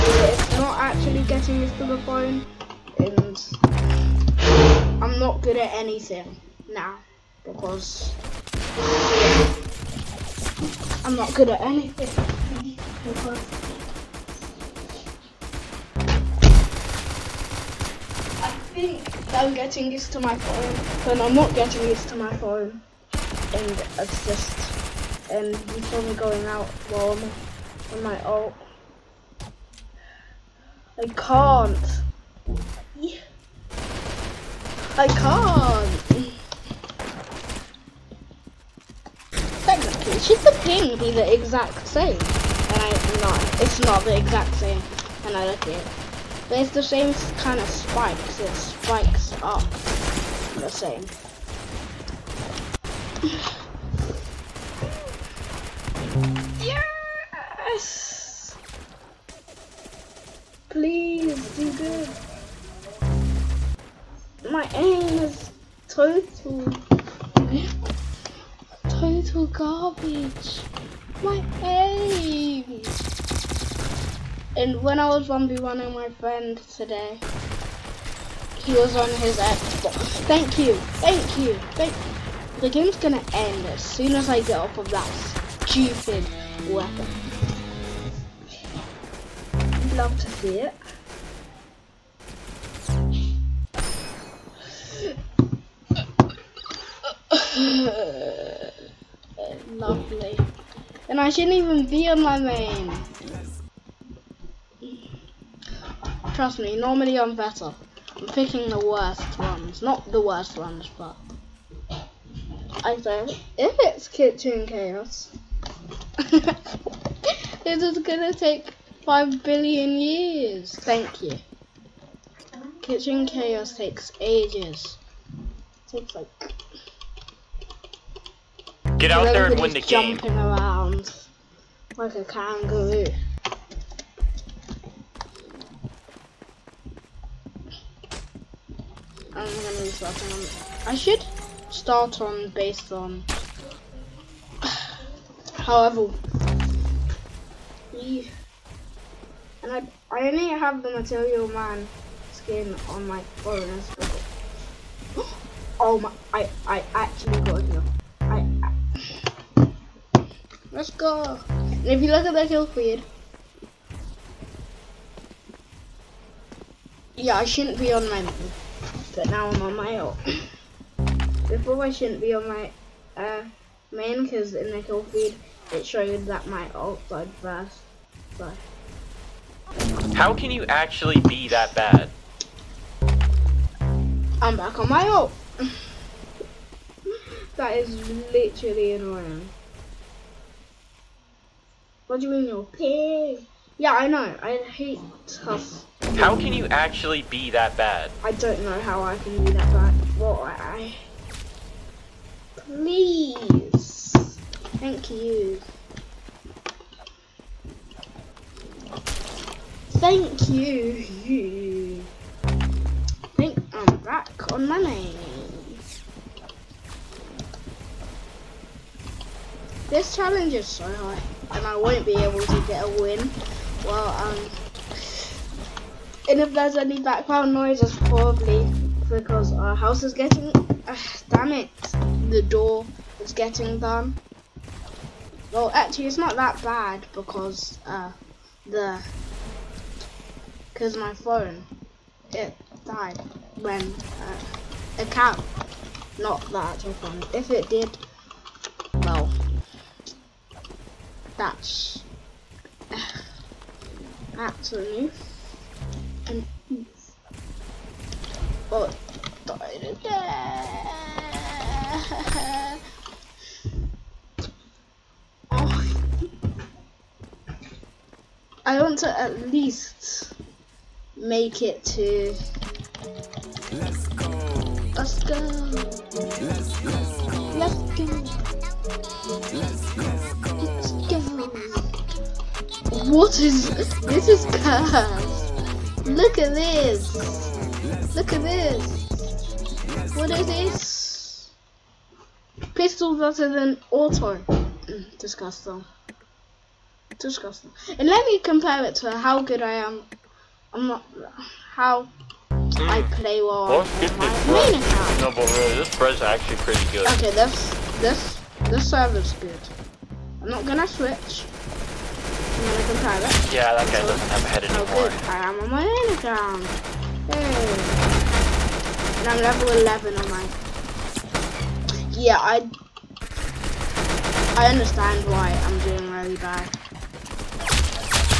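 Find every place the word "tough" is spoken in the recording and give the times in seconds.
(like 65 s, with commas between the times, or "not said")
195 s.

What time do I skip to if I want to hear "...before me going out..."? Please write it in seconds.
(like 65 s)
25 s.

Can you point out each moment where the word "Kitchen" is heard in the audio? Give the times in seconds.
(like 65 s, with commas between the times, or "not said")
114 s, 122 s.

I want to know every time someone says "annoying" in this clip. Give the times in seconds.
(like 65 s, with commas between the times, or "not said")
188 s.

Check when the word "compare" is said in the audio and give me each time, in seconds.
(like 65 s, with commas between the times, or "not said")
298 s, 312 s.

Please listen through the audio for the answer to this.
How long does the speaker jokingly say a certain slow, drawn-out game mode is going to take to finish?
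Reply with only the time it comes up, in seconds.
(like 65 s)
119 s.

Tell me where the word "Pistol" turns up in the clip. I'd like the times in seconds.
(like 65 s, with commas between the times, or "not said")
292 s.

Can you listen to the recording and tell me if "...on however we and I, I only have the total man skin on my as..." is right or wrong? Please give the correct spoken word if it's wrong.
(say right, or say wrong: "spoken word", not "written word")
wrong: "material", not "total".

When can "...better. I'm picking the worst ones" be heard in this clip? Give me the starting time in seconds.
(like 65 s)
107 s.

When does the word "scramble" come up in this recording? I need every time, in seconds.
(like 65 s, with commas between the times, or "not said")
not said.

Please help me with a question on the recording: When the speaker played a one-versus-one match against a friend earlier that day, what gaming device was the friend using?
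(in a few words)
Xbox.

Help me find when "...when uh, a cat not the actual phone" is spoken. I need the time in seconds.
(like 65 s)
243 s.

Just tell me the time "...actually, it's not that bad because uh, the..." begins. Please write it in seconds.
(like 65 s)
235 s.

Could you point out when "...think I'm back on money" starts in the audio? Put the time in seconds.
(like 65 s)
213 s.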